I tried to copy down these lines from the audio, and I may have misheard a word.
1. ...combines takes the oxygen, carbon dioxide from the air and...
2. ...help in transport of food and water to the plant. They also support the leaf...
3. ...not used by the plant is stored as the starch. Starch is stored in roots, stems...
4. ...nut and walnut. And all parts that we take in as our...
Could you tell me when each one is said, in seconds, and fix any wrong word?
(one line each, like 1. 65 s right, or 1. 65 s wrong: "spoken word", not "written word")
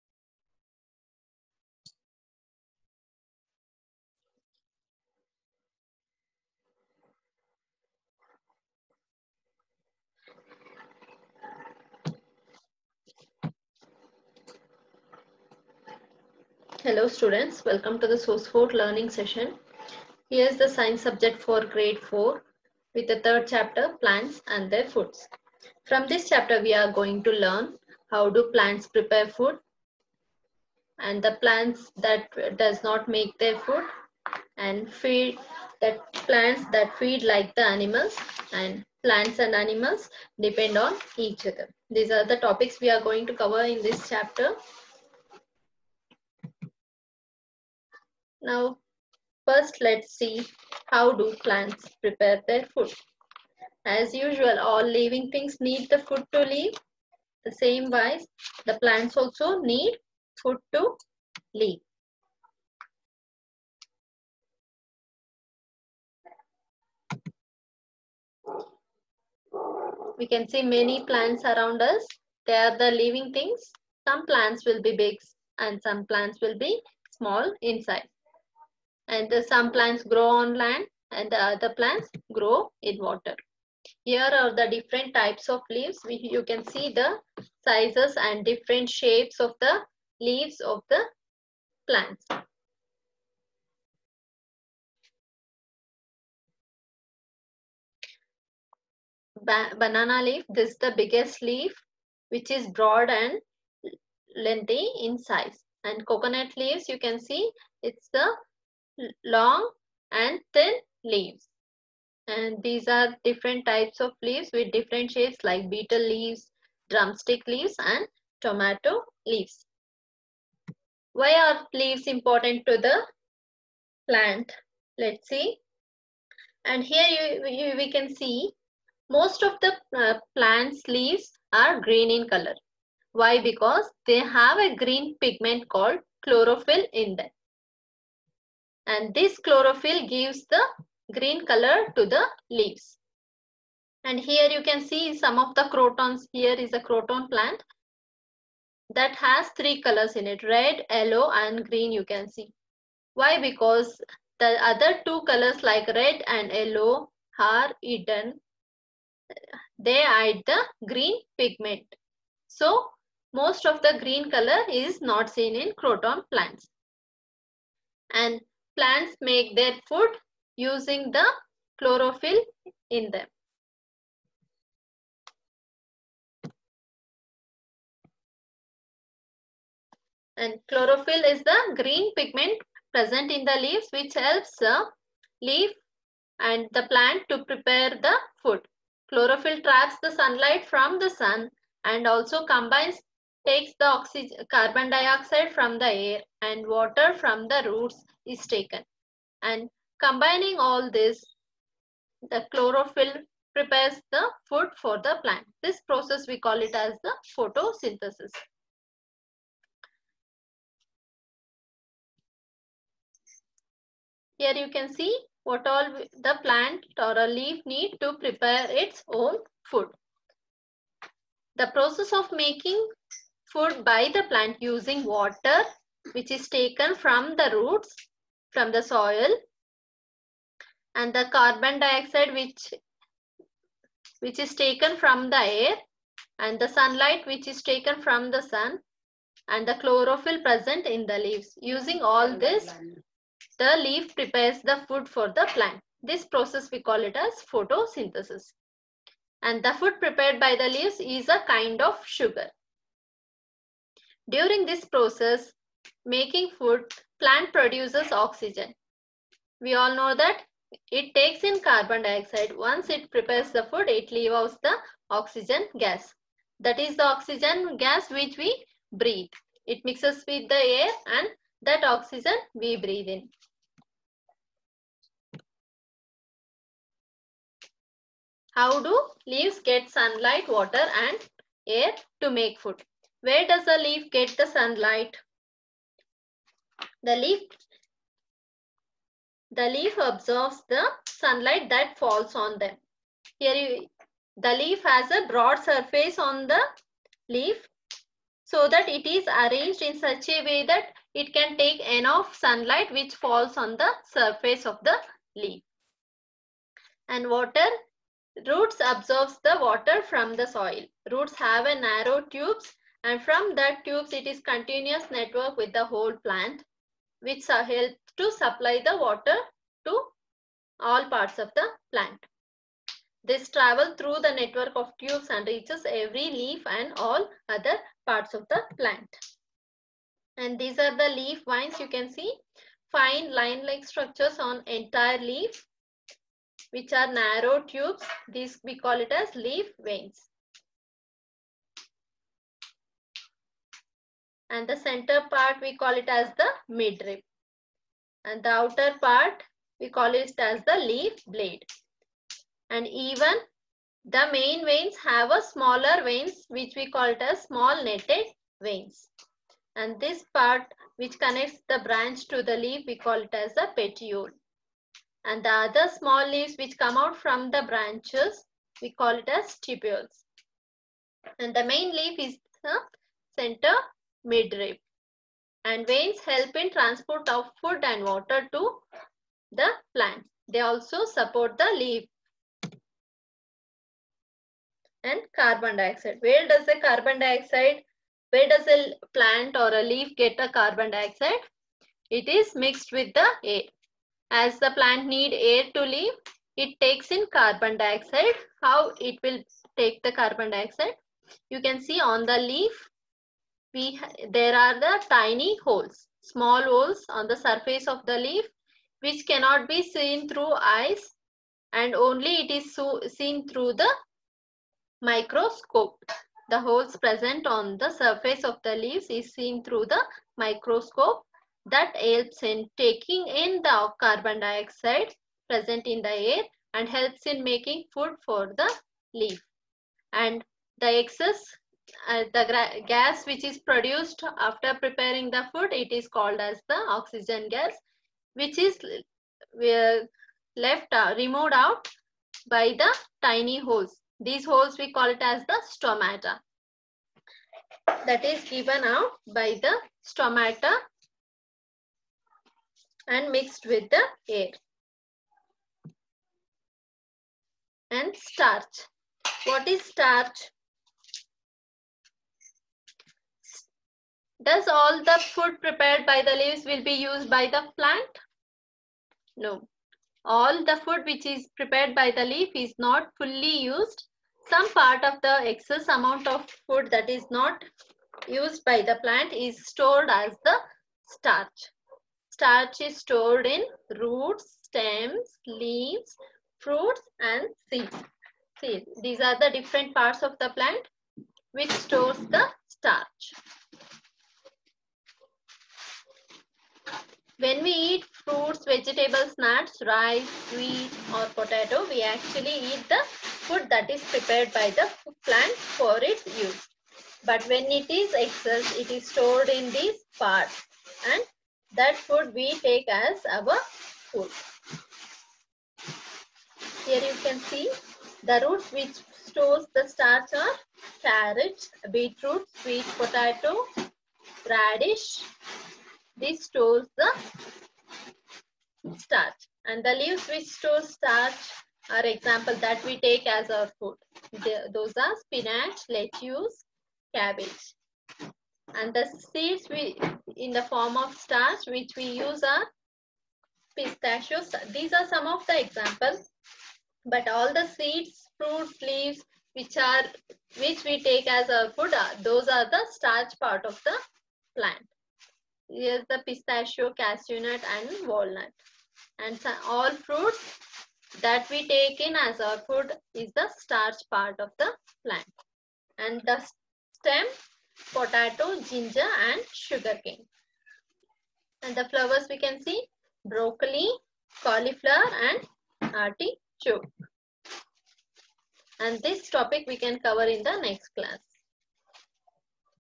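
1. 192 s right
2. 376 s right
3. 477 s right
4. 557 s wrong: "fruits", not "parts".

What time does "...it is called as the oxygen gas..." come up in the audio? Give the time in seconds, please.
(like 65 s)
435 s.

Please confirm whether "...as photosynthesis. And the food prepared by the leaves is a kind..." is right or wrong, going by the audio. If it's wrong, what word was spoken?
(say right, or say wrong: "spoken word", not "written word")
right.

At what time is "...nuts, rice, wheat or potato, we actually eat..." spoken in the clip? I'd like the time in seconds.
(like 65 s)
499 s.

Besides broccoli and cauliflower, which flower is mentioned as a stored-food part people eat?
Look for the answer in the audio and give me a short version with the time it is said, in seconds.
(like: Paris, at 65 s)
Artichoke, at 575 s.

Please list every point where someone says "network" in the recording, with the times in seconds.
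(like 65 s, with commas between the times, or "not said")
315 s, 324 s.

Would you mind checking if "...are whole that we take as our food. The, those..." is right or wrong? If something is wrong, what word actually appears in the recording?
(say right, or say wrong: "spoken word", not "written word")
wrong: "example", not "whole".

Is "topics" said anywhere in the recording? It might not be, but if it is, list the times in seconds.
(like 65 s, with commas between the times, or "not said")
42 s, 579 s.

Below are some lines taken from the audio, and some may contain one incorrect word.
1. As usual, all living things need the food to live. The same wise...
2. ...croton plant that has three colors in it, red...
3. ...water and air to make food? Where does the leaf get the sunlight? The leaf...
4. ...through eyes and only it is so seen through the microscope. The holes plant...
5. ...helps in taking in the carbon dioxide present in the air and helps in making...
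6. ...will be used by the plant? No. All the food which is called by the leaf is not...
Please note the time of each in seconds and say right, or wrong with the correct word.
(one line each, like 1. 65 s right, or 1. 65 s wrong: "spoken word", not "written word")
1. 53 s right
2. 146 s right
3. 280 s right
4. 410 s wrong: "present", not "plant"
5. 421 s right
6. 466 s wrong: "prepared", not "called".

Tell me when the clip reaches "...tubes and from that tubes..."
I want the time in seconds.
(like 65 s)
312 s.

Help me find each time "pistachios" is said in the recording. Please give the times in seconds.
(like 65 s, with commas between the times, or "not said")
543 s, 556 s.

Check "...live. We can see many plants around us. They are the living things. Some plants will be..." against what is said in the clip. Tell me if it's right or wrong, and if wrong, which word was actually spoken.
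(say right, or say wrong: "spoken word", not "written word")
right.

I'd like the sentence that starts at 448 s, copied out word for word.
That is given out by the stomata and mixed with the air and starch.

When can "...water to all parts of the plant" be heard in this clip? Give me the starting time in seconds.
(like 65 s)
318 s.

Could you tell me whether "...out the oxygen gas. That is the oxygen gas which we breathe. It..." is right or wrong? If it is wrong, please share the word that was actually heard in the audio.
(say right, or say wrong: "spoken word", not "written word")
right.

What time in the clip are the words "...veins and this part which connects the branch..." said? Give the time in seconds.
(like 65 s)
358 s.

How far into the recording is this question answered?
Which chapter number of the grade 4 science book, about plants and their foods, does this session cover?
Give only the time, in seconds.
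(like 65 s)
23 s.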